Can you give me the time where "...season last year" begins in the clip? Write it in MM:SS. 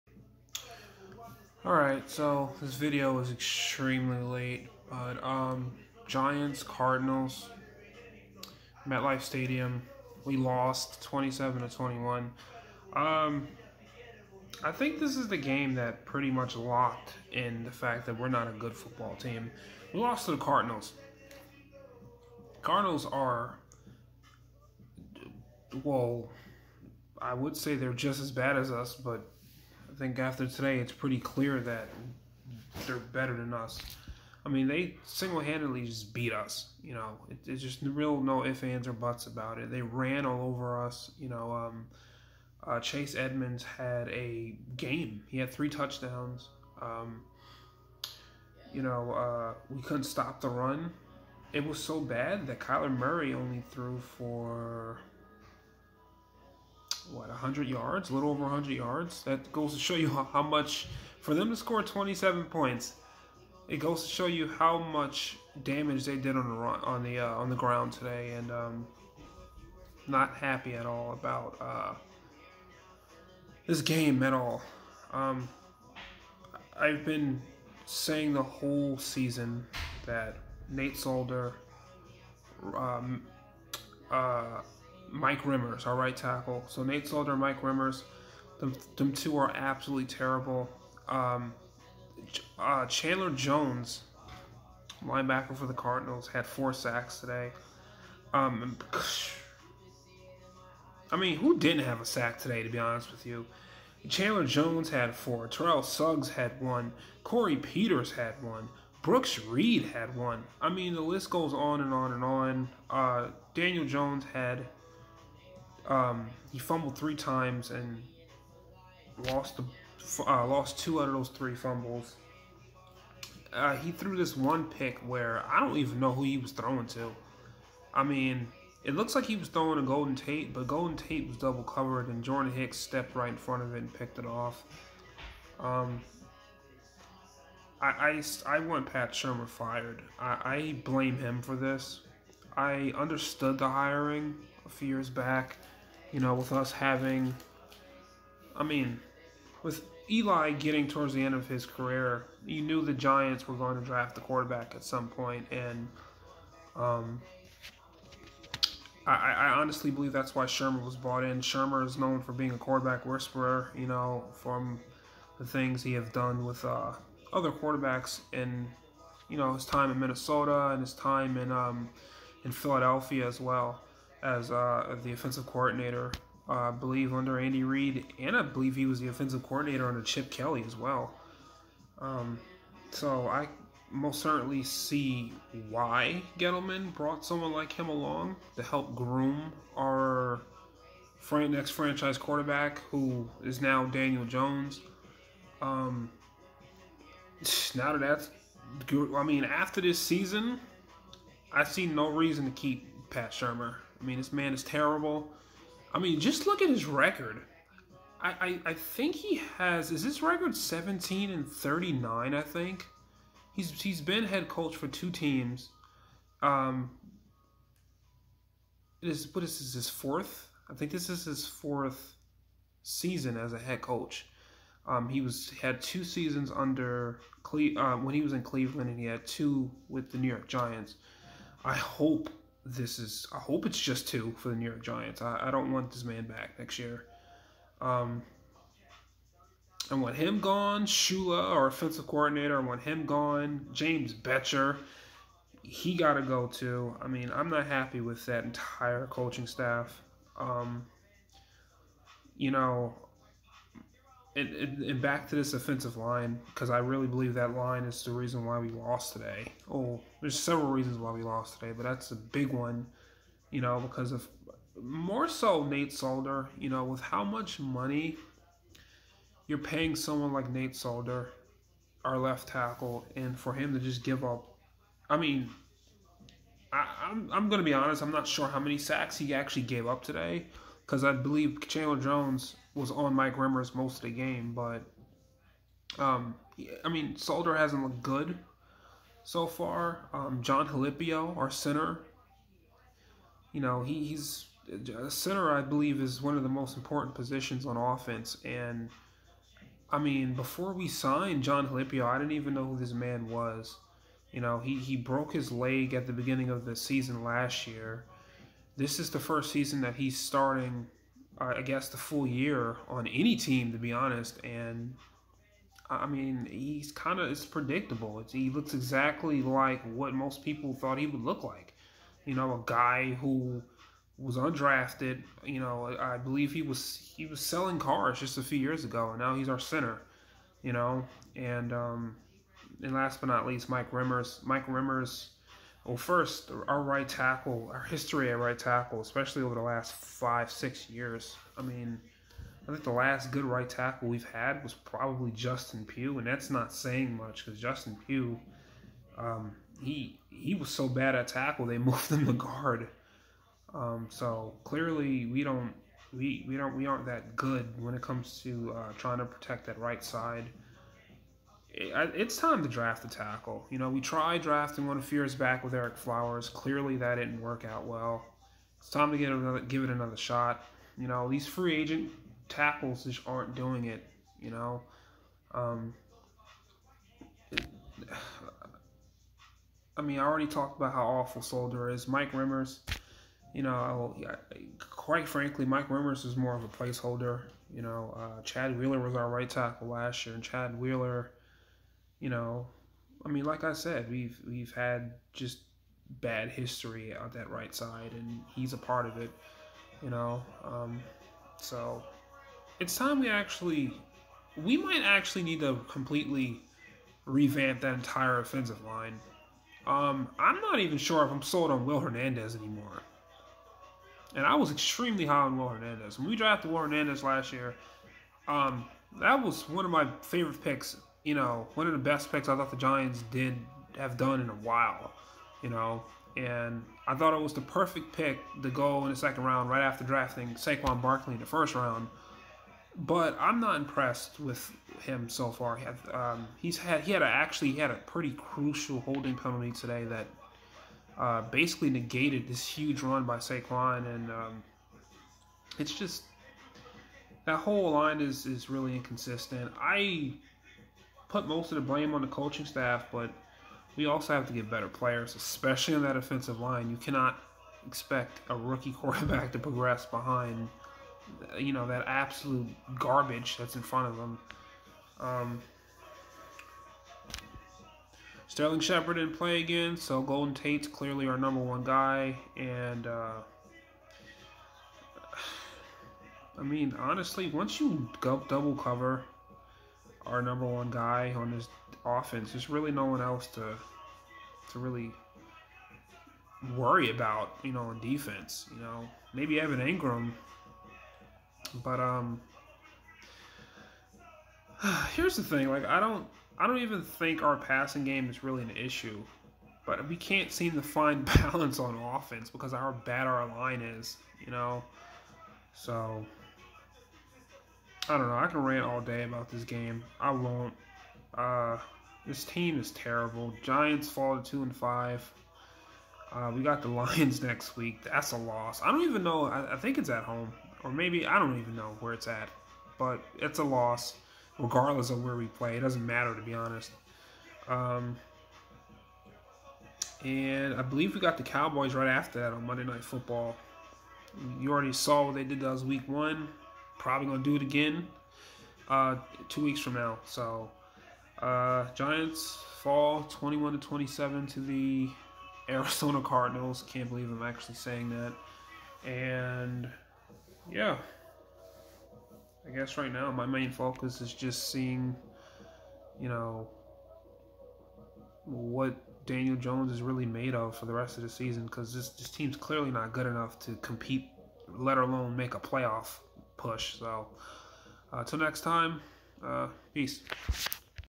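05:06.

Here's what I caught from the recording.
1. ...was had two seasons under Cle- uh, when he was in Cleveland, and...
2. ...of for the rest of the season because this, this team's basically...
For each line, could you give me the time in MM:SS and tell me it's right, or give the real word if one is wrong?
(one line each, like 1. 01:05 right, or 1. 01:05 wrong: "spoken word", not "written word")
1. 03:45 right
2. 09:20 wrong: "clearly", not "basically".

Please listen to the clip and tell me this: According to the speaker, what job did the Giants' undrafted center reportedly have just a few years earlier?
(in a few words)
selling cars.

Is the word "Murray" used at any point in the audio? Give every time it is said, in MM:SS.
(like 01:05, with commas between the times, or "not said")
00:52.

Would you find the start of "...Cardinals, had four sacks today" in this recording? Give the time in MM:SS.
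01:35.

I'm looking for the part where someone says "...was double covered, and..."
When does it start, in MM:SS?
02:11.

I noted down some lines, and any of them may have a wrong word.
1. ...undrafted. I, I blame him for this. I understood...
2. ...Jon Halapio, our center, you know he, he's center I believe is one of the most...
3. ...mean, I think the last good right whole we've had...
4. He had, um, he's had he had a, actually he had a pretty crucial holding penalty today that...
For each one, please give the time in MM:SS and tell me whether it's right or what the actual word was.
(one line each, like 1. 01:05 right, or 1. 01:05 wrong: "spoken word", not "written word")
1. 02:19 wrong: "fired", not "undrafted"
2. 04:50 right
3. 05:41 wrong: "tackle", not "whole"
4. 07:15 right.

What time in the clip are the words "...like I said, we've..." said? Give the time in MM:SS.
06:33.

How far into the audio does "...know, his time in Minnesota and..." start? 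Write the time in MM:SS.
02:49.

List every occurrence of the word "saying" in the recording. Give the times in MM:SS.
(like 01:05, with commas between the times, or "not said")
01:17, 05:46, 09:07.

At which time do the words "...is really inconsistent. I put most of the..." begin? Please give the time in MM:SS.
07:28.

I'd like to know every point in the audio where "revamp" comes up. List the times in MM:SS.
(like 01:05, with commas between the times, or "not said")
06:47.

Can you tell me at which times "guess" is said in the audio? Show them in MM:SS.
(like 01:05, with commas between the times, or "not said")
05:11, 09:12.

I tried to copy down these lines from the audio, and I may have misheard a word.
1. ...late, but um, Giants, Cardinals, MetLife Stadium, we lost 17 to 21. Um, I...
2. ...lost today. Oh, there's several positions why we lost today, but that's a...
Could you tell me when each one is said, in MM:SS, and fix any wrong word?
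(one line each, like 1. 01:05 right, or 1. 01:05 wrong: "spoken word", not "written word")
1. 00:04 wrong: "27", not "17"
2. 04:18 wrong: "reasons", not "positions".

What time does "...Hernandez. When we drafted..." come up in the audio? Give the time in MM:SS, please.
06:55.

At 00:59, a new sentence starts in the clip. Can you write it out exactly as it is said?
That goes to show you how, how much for them to score 27 points.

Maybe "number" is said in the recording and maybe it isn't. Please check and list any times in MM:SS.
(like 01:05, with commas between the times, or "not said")
07:51, 08:00.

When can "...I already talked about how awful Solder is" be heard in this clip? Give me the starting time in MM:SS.
06:20.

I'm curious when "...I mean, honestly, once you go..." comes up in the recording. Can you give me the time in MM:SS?
07:56.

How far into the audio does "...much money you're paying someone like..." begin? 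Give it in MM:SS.
04:27.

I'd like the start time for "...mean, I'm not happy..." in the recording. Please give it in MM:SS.
04:07.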